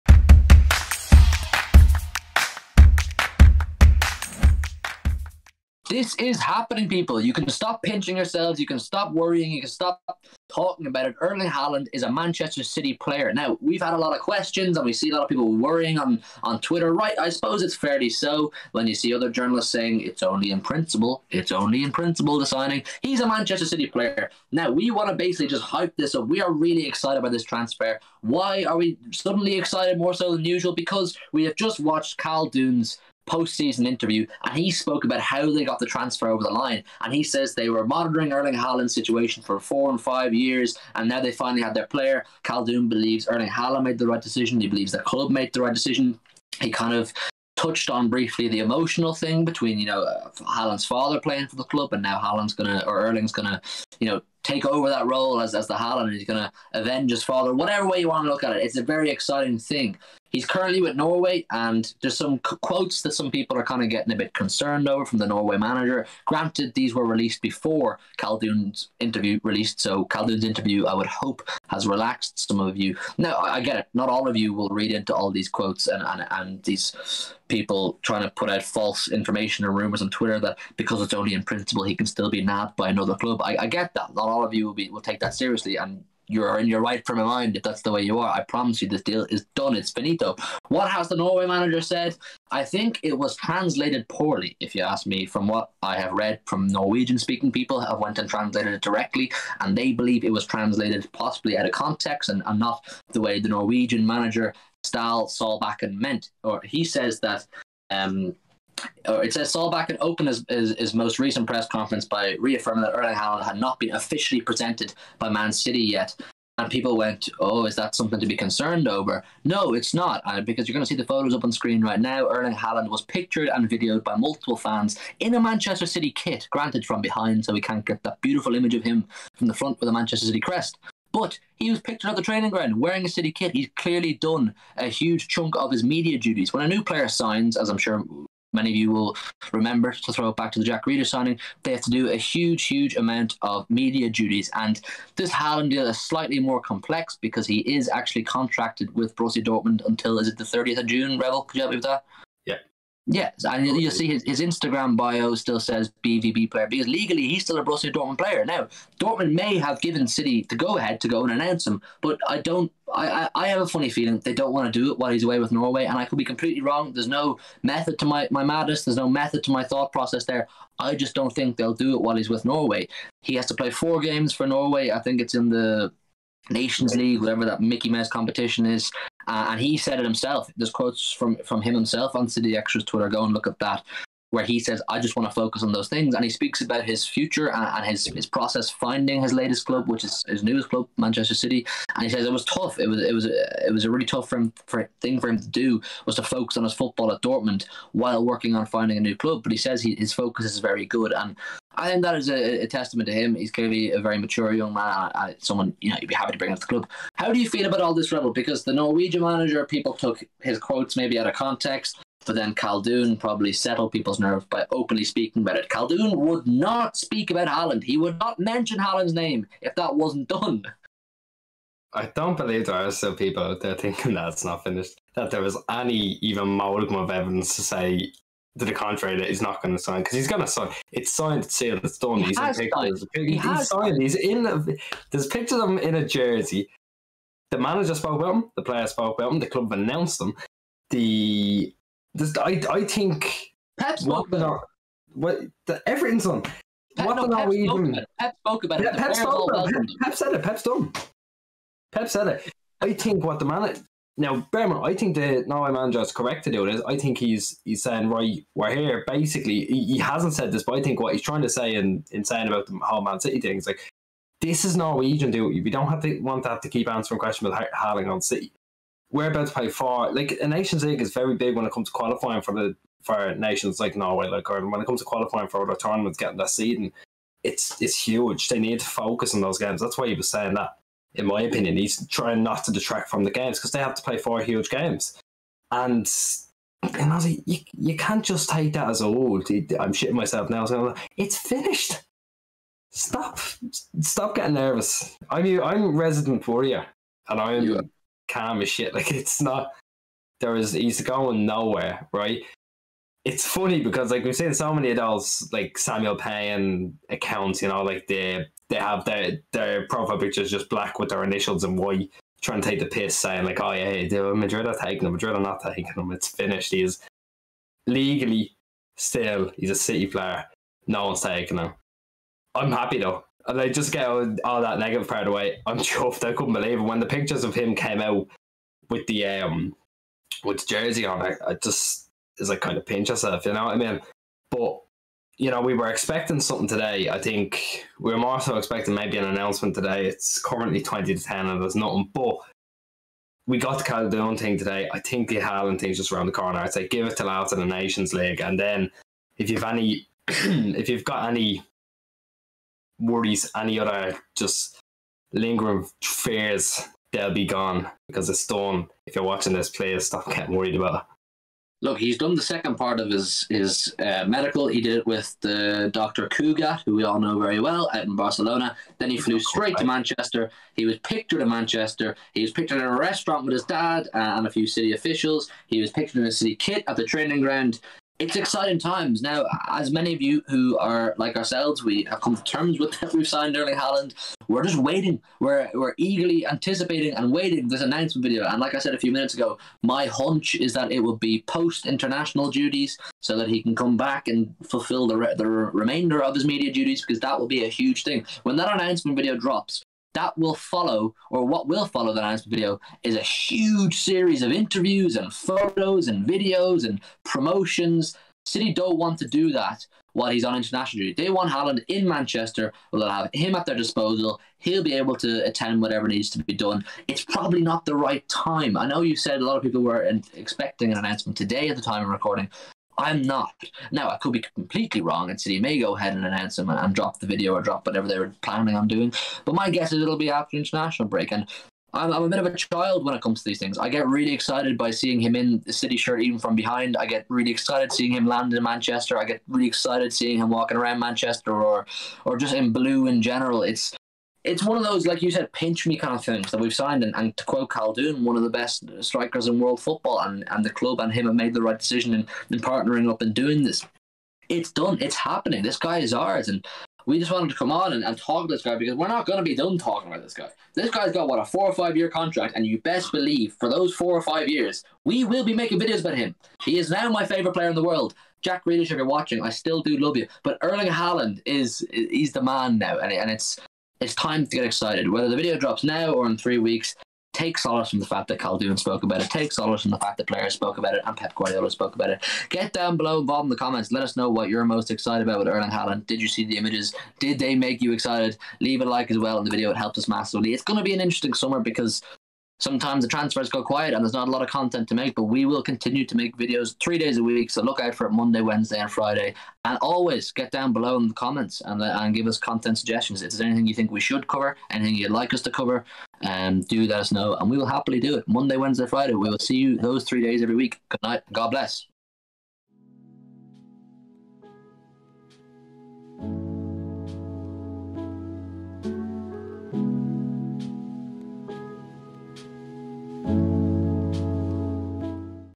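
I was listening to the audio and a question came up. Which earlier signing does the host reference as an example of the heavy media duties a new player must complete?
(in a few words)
Jack Grealish.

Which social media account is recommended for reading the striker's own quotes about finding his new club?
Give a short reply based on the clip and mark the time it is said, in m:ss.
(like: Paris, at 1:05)
City Xtra, at 3:02.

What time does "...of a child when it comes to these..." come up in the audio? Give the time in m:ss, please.
7:12.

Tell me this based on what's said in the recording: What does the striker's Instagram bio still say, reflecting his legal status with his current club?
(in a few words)
BVB player.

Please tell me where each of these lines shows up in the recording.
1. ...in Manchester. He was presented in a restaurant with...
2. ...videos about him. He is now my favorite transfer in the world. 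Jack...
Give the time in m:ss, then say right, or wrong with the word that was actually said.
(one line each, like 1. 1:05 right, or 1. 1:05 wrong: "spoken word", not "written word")
1. 6:11 wrong: "pictured", not "presented"
2. 7:45 wrong: "player", not "transfer".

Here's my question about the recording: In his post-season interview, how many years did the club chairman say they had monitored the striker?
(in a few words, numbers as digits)
4 and 5 years.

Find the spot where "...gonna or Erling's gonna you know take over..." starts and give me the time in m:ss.
0:52.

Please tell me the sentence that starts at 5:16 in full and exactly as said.
He's legally still he's a City player.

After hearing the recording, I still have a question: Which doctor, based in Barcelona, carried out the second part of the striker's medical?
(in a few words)
Dr. Cugat.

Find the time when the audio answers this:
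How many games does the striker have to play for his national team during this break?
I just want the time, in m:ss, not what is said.
2:53.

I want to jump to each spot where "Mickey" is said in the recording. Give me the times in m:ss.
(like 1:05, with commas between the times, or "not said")
2:57.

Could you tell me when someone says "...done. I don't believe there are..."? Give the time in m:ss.
3:40.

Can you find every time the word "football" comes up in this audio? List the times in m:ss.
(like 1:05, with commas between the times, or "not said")
3:16, 7:29.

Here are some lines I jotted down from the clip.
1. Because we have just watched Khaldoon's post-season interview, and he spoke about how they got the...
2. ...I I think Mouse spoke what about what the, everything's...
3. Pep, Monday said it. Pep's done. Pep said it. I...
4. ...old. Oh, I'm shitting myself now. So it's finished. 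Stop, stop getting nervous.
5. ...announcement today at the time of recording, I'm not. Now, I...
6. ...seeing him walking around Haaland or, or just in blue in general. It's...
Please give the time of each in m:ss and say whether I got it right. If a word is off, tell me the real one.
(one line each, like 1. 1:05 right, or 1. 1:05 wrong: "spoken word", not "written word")
1. 0:30 right
2. 4:02 wrong: "Pep", not "Mouse"
3. 4:09 wrong: "Pep", not "Monday"
4. 4:49 right
5. 7:00 right
6. 7:20 wrong: "Manchester", not "Haaland".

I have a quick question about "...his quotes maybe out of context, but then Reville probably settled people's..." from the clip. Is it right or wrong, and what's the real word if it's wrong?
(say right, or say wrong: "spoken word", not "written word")
wrong: "Khaldoon", not "Reville".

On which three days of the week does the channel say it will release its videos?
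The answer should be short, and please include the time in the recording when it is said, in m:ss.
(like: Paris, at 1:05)
Monday, Wednesday, Friday, at 8:18.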